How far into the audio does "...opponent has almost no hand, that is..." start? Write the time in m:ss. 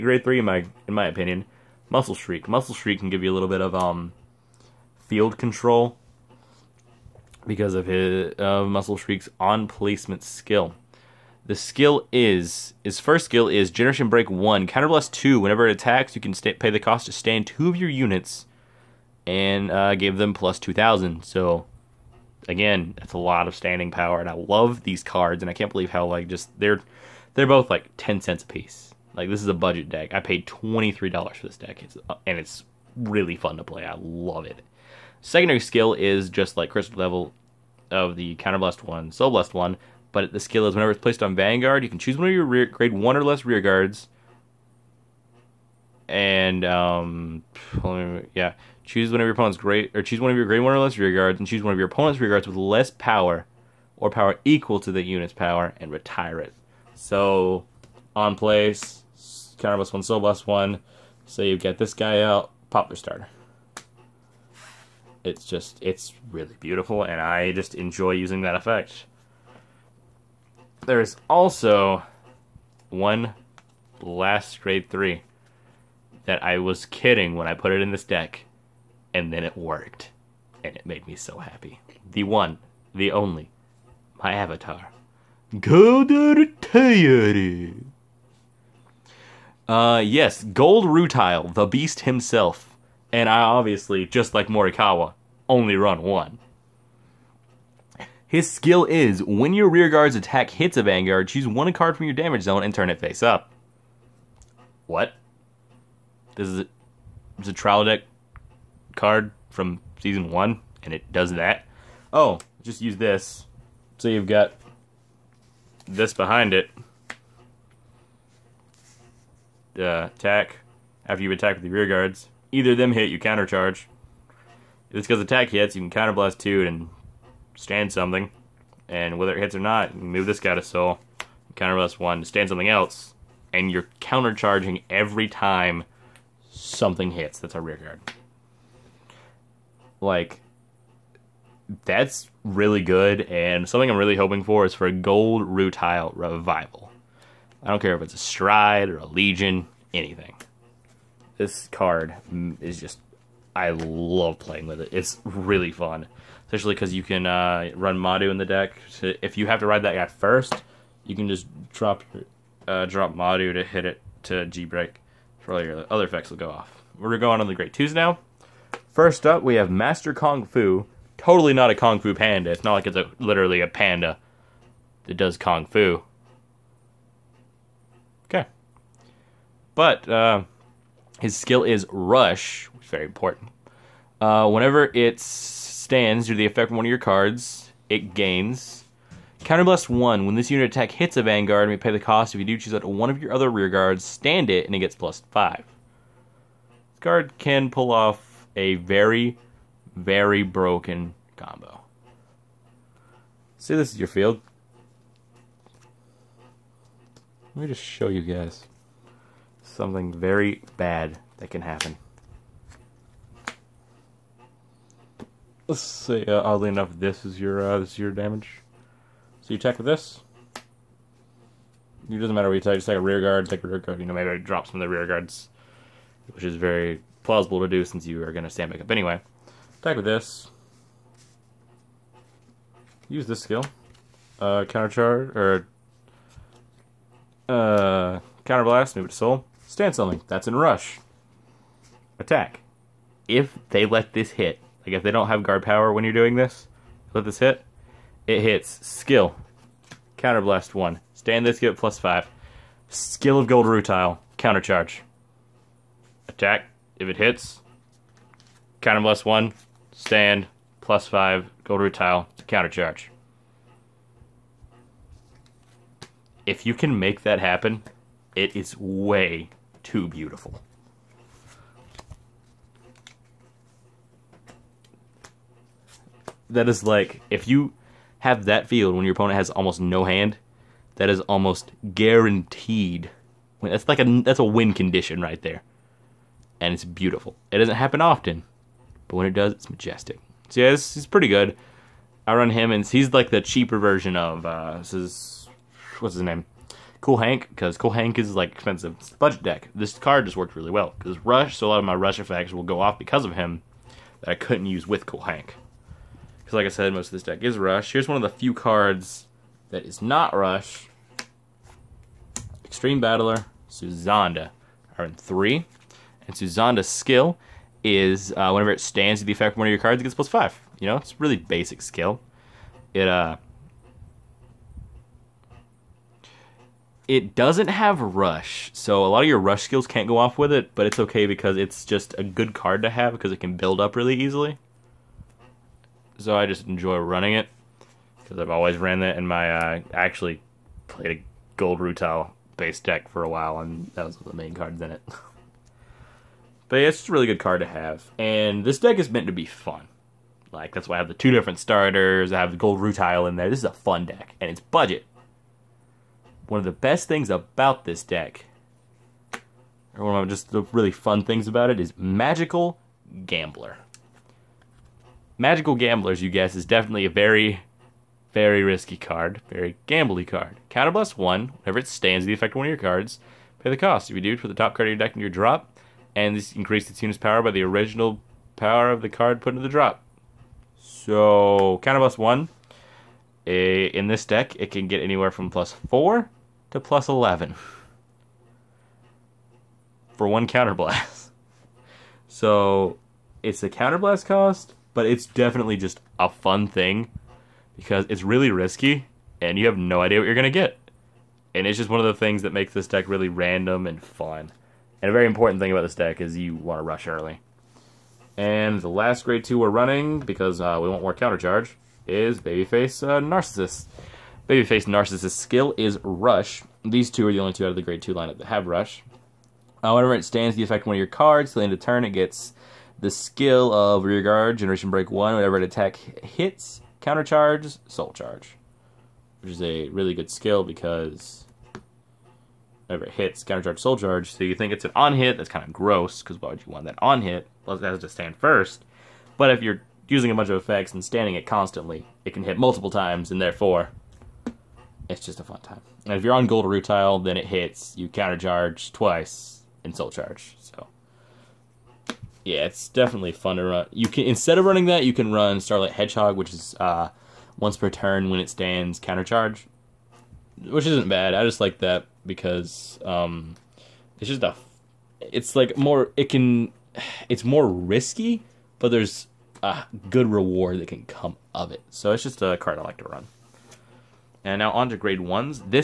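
4:39.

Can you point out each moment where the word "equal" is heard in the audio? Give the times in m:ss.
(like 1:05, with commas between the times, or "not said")
0:54.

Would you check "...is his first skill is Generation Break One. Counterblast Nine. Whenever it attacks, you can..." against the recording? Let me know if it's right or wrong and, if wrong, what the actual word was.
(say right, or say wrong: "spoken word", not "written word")
wrong: "Two", not "Nine".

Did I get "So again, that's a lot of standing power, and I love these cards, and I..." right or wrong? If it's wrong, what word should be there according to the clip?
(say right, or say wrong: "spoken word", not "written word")
right.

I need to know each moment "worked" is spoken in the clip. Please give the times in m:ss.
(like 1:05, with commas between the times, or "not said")
1:19, 5:00.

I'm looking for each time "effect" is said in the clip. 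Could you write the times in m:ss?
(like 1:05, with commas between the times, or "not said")
1:08, 2:46, 3:06, 5:02, 5:19, 6:12, 7:00, 7:20.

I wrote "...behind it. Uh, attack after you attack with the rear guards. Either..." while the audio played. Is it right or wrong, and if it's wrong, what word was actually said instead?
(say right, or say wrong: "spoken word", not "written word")
right.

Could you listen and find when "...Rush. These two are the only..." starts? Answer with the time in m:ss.
6:56.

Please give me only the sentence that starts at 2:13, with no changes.
And you're countercharging every time something hits.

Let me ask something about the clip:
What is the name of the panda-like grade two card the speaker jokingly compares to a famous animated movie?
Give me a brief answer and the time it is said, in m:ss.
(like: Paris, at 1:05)
Master Kung Fu, at 2:49.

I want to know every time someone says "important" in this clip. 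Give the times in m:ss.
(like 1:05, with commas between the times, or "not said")
3:03, 6:45.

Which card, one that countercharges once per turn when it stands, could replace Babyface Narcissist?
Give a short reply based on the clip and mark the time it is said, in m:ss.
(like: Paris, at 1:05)
Starlight Hedgehog, at 7:35.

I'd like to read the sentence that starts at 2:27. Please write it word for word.
I don't care if it's a stride or a legion, anything.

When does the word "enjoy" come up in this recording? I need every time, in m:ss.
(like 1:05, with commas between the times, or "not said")
1:07, 5:36.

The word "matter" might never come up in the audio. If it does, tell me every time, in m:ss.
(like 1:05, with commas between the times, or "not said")
3:42.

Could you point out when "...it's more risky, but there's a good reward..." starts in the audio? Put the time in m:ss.
7:47.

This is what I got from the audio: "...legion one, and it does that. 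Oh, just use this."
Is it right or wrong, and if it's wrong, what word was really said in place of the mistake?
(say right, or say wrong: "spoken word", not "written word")
wrong: "season", not "legion".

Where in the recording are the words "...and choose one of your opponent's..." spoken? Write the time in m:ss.
0:51.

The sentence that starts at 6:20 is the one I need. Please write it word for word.
So, Counterblast 1, eh, in this deck, it can get anywhere from plus 4 to plus 11 for one counterblast.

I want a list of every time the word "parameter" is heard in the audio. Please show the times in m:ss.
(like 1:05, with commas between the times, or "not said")
not said.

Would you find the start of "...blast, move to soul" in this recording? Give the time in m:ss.
3:58.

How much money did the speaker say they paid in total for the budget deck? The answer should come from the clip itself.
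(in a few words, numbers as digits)
$23.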